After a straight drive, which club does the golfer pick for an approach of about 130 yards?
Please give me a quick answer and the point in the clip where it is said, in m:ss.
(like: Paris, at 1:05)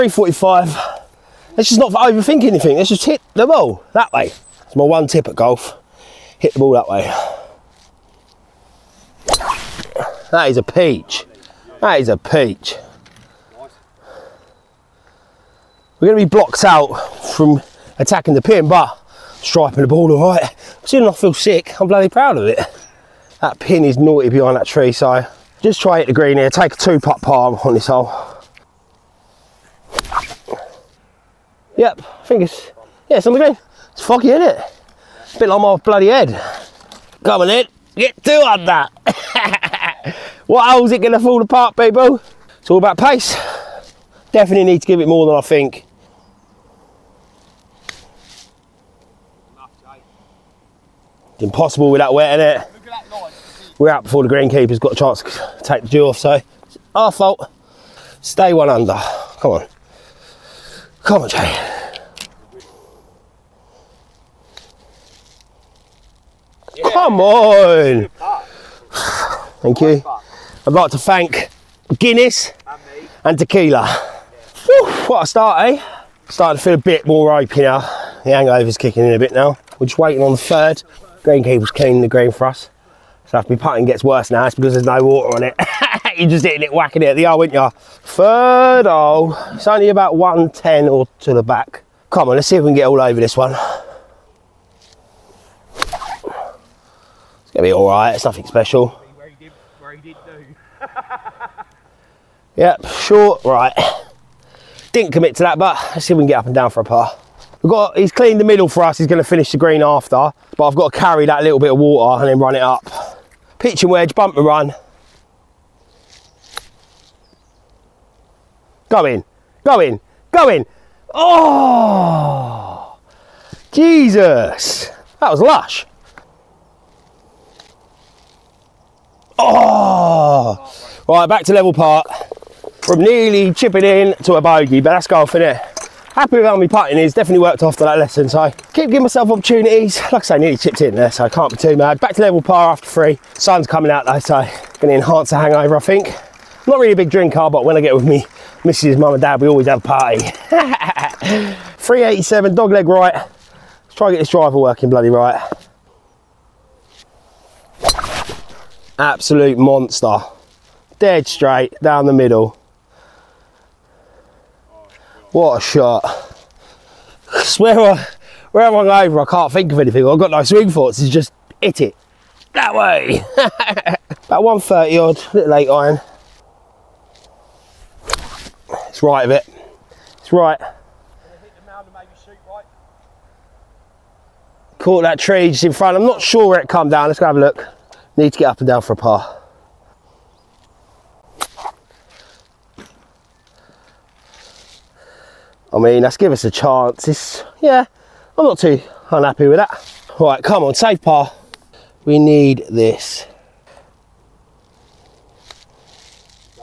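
eight iron, at 2:55.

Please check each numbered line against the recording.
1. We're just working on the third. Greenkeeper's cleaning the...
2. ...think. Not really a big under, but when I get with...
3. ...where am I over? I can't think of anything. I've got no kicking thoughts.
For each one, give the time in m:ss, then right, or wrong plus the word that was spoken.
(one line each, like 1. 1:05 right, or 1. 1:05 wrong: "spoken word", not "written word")
1. 1:19 wrong: "waiting", not "working"
2. 2:25 wrong: "drinker", not "under"
3. 2:48 wrong: "swing", not "kicking".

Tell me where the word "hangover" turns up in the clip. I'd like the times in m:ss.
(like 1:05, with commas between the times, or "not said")
1:18, 2:25.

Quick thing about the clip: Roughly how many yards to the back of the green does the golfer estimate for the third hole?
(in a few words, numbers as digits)
110.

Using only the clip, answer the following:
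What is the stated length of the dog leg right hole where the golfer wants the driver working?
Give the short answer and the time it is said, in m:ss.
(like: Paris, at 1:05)
387, at 2:31.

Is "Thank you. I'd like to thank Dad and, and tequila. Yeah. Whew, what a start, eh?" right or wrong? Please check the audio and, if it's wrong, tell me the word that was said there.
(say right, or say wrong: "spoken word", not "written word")
wrong: "Guinness", not "Dad".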